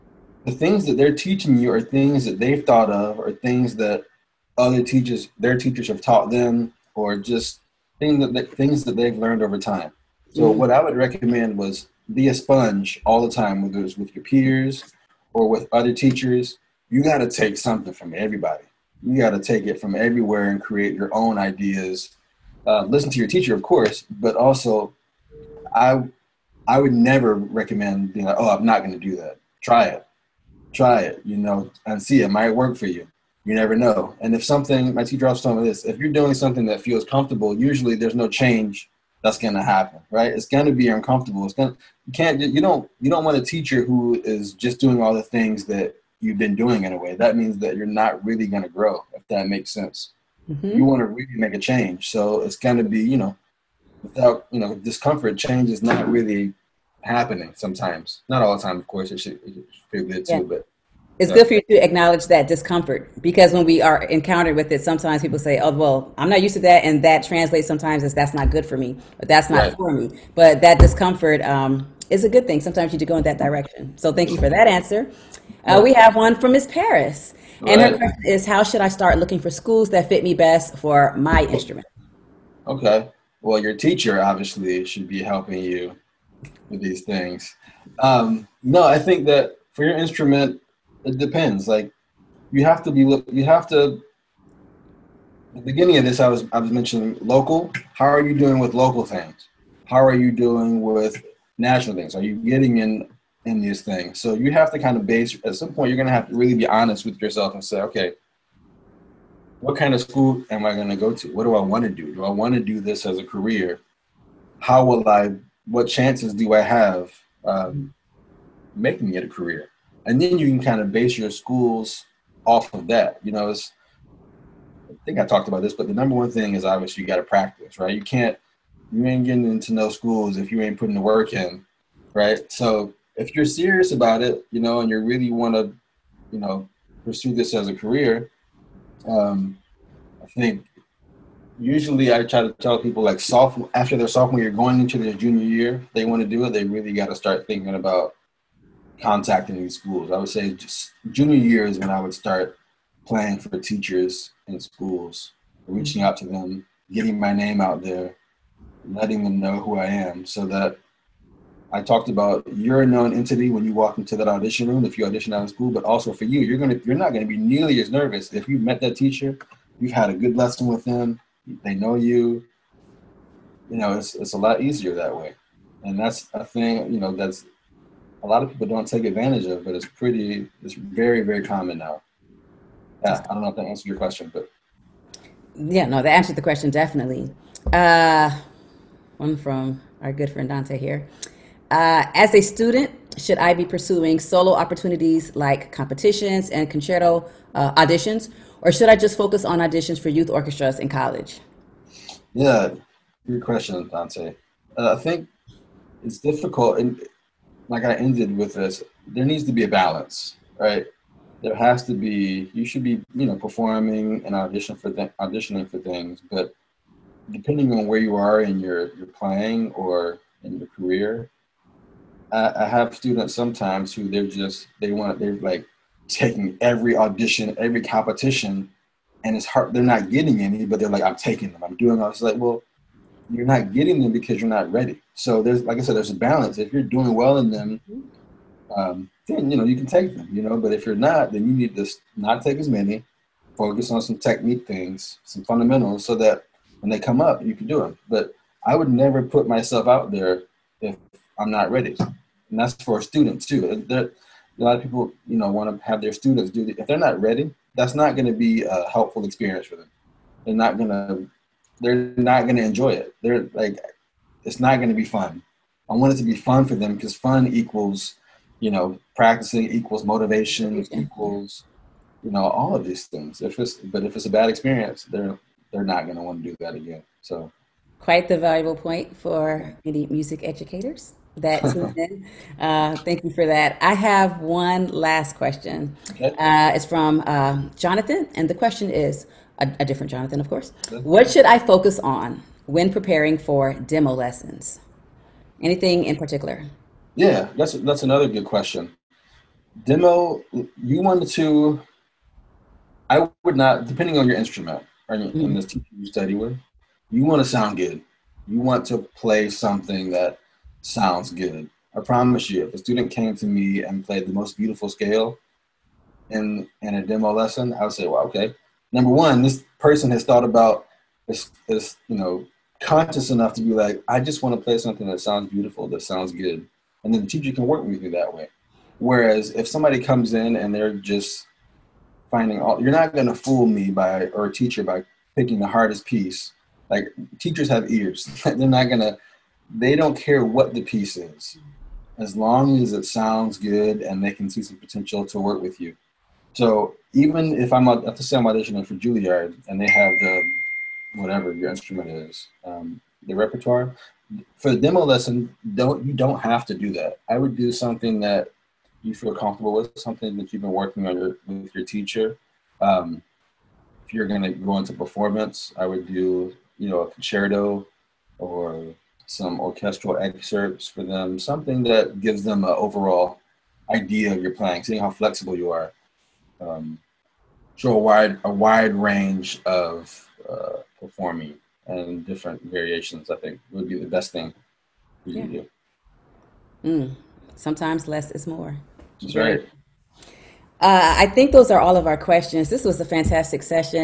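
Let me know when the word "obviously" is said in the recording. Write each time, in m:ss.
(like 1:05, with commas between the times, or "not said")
1:24, 2:06.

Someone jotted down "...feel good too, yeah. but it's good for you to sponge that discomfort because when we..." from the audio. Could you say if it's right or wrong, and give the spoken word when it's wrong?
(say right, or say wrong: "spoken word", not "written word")
wrong: "acknowledge", not "sponge".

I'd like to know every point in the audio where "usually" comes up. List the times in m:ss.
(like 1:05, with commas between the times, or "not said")
0:37, 2:21.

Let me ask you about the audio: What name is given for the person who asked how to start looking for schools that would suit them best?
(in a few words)
Miss Paris.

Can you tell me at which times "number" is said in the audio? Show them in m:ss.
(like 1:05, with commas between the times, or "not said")
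2:05, 5:18.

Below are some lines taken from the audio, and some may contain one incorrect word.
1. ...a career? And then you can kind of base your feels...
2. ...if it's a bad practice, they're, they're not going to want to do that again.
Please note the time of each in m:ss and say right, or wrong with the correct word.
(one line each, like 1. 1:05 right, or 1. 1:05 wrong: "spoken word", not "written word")
1. 1:59 wrong: "schools", not "feels"
2. 4:34 wrong: "experience", not "practice".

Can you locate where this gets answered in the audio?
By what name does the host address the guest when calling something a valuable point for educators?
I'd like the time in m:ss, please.
4:41.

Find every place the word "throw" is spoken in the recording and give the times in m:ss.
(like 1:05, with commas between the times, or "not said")
not said.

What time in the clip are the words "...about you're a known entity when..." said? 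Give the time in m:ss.
2:42.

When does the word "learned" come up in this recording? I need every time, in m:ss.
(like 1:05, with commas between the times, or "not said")
0:09.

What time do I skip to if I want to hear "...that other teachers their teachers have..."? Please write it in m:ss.
0:03.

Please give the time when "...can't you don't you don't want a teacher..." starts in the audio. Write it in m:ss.
0:42.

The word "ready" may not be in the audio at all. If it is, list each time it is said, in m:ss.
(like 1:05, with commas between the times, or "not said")
3:54, 4:11, 4:17.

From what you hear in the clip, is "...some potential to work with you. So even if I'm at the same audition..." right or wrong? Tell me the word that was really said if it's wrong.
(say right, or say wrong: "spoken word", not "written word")
right.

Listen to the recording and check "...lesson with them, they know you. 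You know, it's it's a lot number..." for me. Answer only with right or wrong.
wrong.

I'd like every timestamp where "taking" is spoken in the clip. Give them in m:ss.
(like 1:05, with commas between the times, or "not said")
3:46, 3:51.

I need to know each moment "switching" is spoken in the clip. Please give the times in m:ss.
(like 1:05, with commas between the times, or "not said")
not said.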